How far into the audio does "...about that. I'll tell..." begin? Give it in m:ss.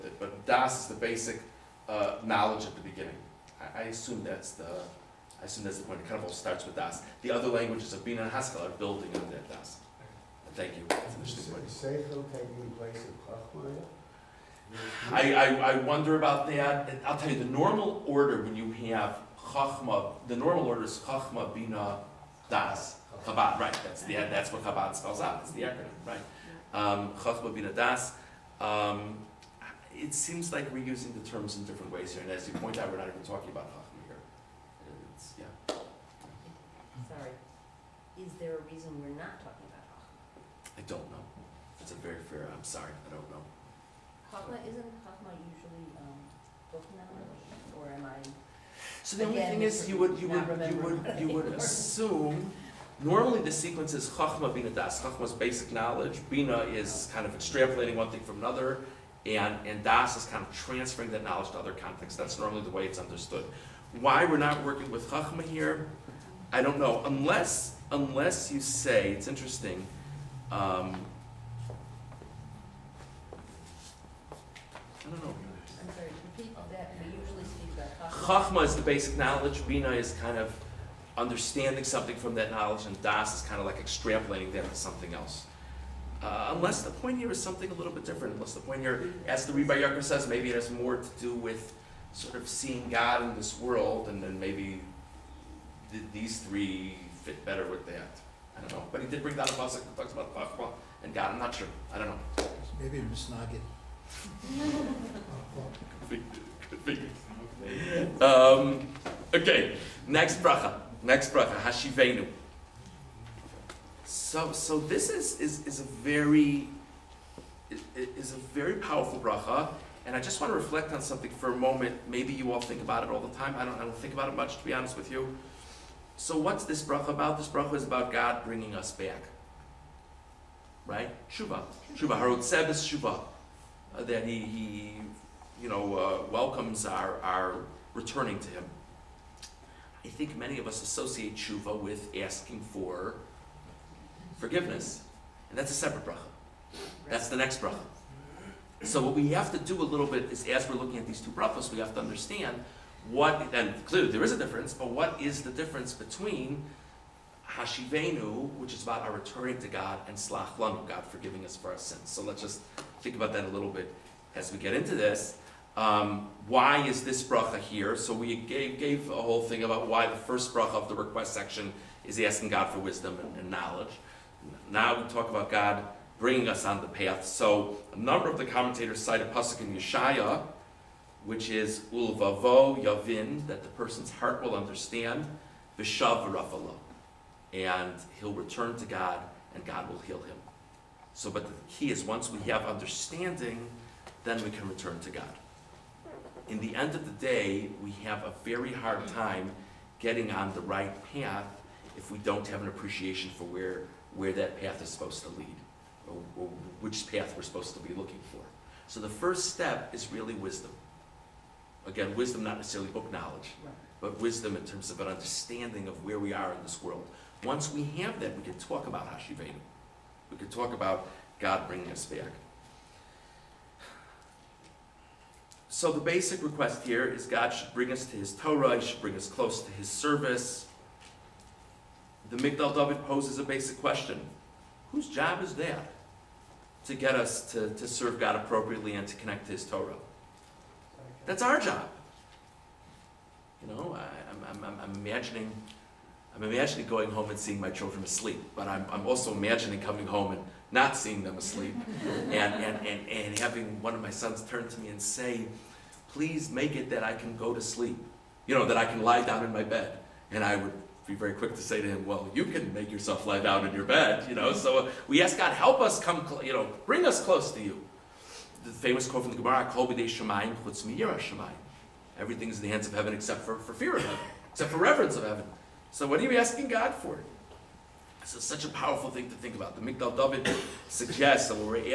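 0:16.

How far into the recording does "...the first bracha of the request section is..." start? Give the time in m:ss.
2:50.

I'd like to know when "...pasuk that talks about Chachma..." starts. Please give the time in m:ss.
1:39.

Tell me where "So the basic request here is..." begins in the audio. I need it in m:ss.
3:45.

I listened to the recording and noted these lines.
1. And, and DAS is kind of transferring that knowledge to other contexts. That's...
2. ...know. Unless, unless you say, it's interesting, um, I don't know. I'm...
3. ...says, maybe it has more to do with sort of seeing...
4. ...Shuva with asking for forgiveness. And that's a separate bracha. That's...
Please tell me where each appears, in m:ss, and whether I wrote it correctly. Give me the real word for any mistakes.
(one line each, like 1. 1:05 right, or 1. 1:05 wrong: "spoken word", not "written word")
1. 0:59 right
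2. 1:06 right
3. 1:30 right
4. 2:21 right.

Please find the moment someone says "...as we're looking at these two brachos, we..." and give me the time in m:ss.
2:30.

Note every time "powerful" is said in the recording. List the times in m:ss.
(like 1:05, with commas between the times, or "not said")
1:58, 4:38.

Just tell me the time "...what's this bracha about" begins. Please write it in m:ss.
2:06.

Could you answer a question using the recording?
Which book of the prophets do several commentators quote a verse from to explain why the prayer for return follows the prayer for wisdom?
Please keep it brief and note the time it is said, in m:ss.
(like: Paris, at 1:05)
Yeshaya, at 2:59.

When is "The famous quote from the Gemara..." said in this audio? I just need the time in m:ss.
4:28.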